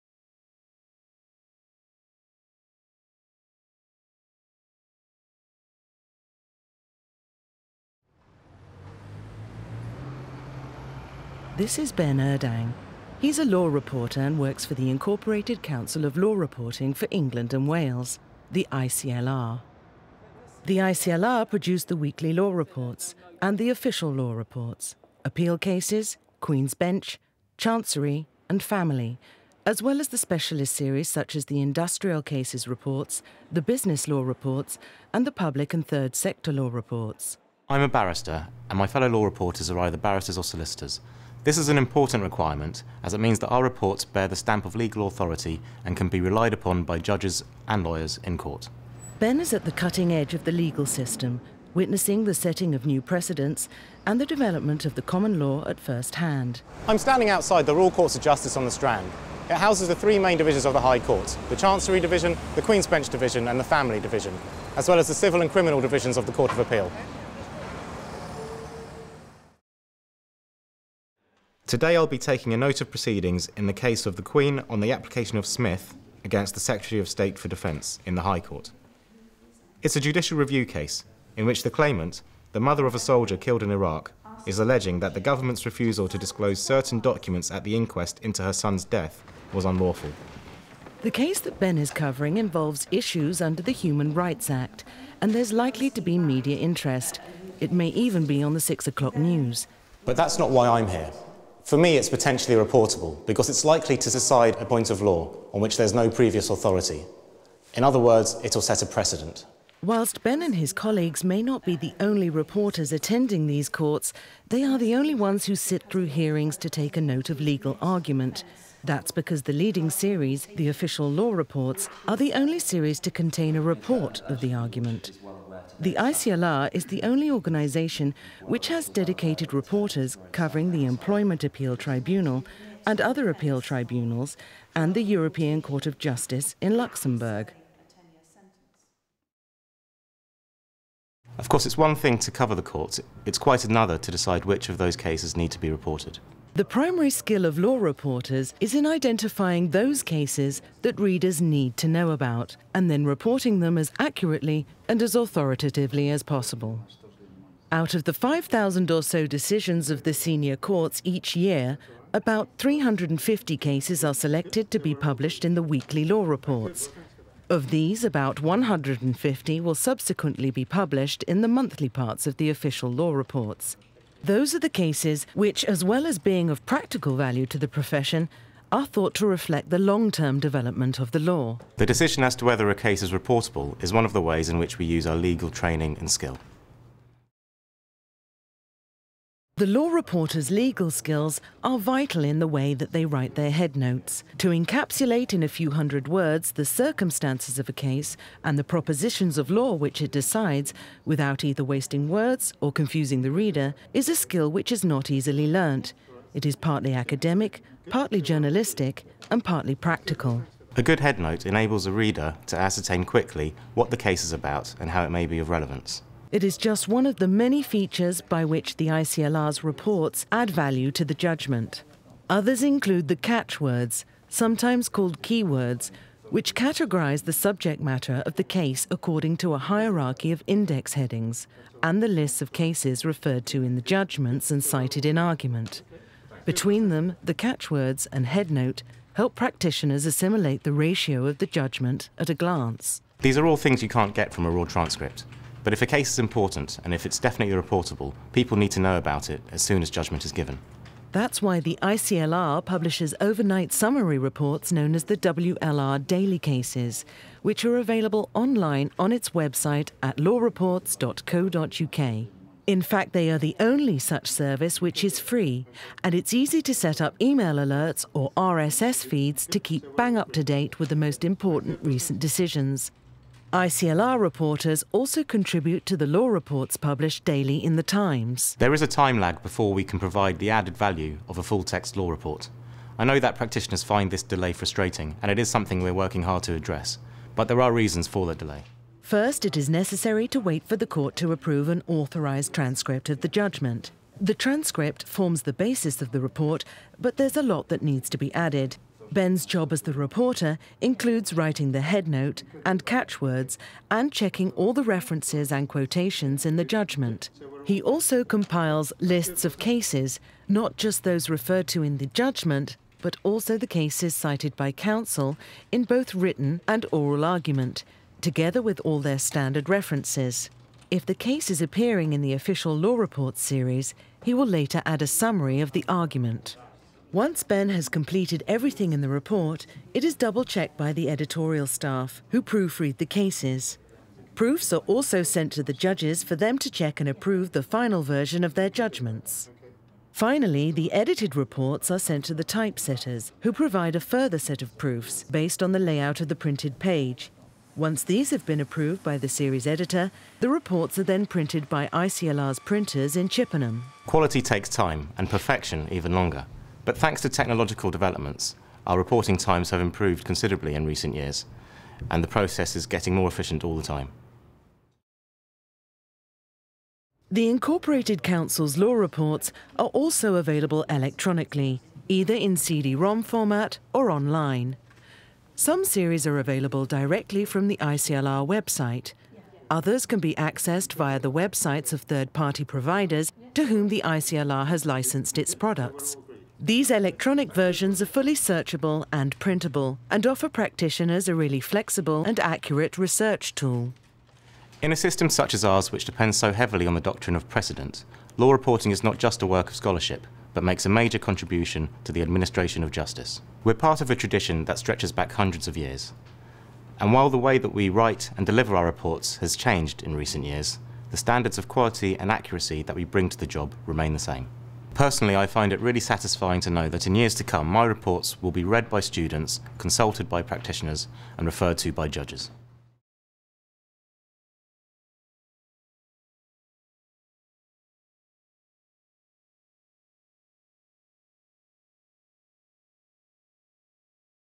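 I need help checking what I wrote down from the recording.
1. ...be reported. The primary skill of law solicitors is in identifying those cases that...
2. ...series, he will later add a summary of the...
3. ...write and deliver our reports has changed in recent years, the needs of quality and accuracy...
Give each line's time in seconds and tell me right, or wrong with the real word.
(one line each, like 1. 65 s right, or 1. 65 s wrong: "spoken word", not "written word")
1. 145 s wrong: "reporters", not "solicitors"
2. 323 s right
3. 407 s wrong: "standards", not "needs".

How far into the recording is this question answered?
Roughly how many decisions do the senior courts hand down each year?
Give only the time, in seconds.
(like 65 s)
158 s.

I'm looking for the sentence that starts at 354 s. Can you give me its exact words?
Quality takes time, and perfection even longer.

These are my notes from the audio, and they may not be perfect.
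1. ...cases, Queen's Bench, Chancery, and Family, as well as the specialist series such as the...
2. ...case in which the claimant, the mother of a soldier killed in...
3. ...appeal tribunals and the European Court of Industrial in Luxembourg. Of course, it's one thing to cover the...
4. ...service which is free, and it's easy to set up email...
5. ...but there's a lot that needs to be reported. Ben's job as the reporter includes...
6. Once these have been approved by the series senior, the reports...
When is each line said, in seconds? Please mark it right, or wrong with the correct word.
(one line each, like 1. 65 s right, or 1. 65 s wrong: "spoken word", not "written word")
1. 25 s right
2. 80 s right
3. 133 s wrong: "Justice", not "Industrial"
4. 264 s right
5. 296 s wrong: "added", not "reported"
6. 347 s wrong: "editor", not "senior".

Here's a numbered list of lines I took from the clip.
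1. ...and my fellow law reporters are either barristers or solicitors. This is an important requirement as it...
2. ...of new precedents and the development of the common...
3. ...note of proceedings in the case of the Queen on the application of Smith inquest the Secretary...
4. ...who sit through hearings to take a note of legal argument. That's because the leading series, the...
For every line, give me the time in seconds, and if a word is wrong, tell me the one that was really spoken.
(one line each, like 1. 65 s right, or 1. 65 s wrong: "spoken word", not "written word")
1. 38 s right
2. 52 s right
3. 72 s wrong: "against", not "inquest"
4. 115 s right.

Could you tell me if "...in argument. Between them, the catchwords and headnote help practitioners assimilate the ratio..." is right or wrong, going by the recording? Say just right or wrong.
right.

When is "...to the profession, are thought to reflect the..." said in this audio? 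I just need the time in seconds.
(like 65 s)
177 s.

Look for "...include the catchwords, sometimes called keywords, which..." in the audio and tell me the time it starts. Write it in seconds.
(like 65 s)
222 s.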